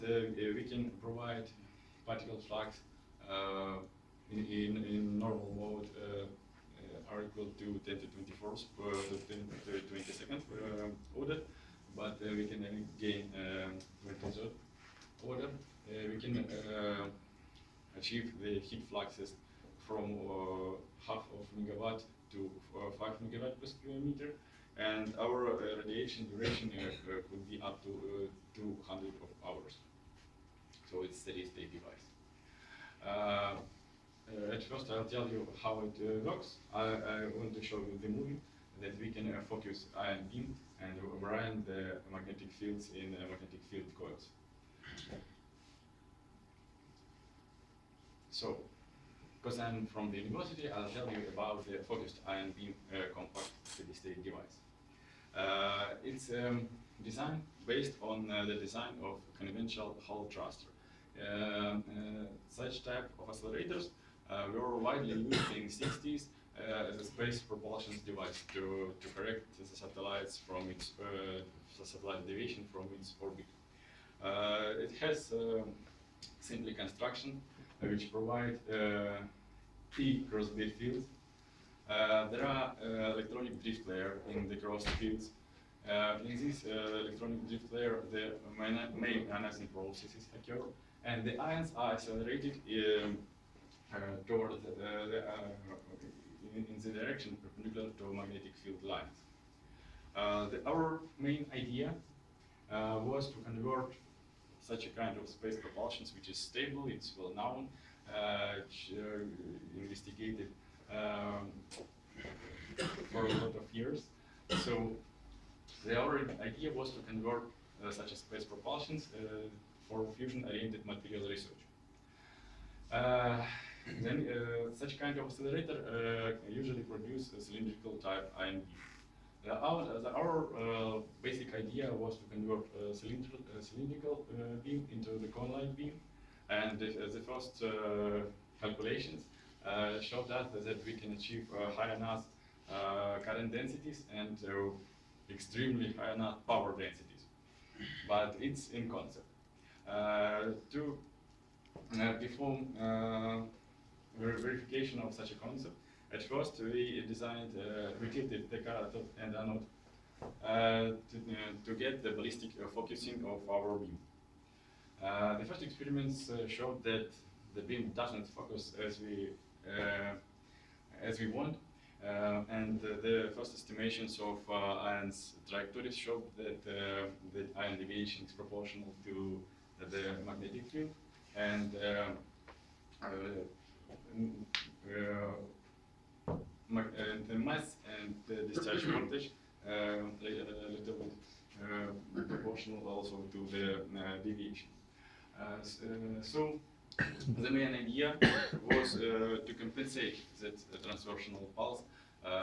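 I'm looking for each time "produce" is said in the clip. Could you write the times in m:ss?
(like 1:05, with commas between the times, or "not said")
2:06.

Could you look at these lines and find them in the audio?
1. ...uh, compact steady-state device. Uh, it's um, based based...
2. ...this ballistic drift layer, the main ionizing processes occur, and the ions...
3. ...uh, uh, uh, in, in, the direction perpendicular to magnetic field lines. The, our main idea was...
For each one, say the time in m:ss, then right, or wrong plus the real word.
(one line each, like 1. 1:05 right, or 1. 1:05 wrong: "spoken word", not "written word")
1. 0:52 wrong: "designed", not "based"
2. 1:26 wrong: "electronic", not "ballistic"
3. 1:34 right.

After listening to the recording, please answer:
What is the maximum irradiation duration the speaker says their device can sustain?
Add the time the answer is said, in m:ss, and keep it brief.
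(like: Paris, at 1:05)
200 hours, at 0:28.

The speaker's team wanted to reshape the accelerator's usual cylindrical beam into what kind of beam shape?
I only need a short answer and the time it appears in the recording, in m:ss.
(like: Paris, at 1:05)
cone-like, at 2:15.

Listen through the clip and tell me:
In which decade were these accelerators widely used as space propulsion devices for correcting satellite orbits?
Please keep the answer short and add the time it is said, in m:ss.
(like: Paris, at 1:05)
60s, at 1:05.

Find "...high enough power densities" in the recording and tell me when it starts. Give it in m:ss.
2:25.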